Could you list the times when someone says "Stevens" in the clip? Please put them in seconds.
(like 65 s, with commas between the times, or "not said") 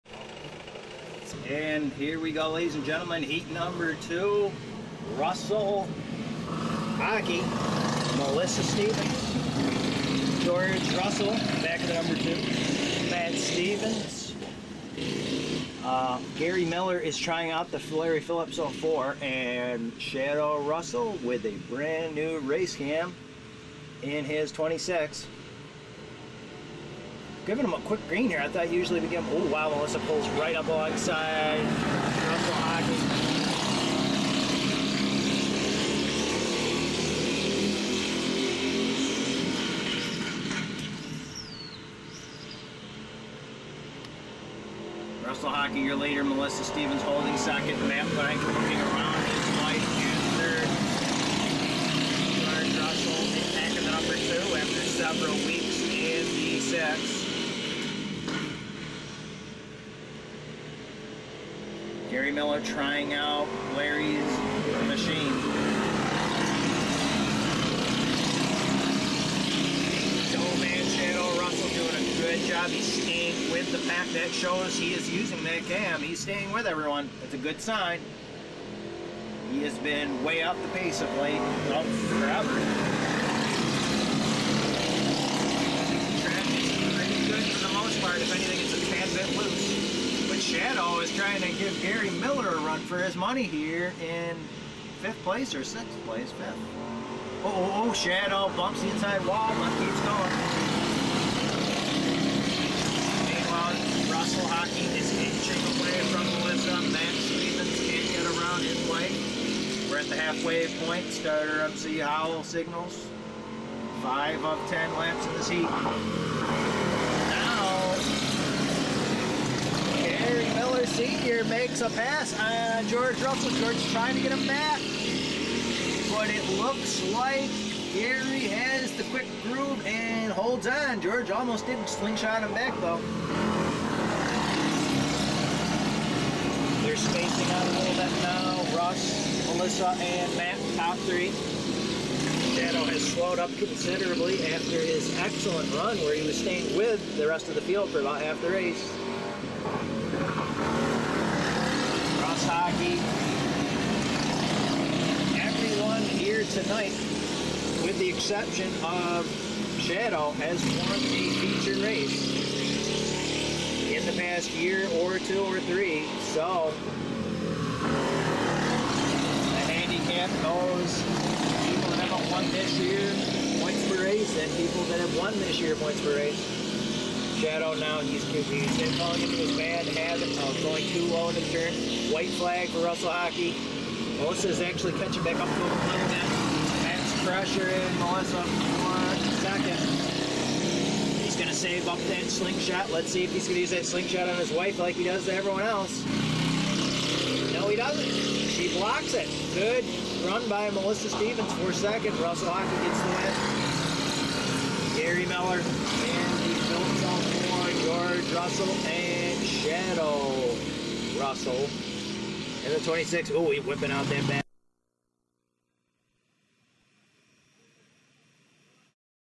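8 s, 13 s, 46 s, 107 s, 201 s.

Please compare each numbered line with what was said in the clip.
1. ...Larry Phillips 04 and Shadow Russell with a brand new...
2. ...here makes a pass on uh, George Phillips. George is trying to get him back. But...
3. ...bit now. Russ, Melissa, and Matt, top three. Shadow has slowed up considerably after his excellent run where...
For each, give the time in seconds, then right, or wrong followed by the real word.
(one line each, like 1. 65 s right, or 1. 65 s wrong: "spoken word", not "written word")
1. 17 s right
2. 121 s wrong: "Russell", not "Phillips"
3. 137 s right.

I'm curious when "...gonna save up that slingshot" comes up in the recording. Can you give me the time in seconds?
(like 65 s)
191 s.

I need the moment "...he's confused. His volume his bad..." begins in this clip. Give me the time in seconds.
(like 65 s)
177 s.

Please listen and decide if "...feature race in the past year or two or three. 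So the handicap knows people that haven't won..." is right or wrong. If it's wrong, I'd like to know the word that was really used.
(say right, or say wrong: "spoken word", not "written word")
right.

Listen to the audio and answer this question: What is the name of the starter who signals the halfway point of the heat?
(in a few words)
Z Howell.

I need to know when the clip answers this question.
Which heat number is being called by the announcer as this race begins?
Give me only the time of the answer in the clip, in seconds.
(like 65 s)
3 s.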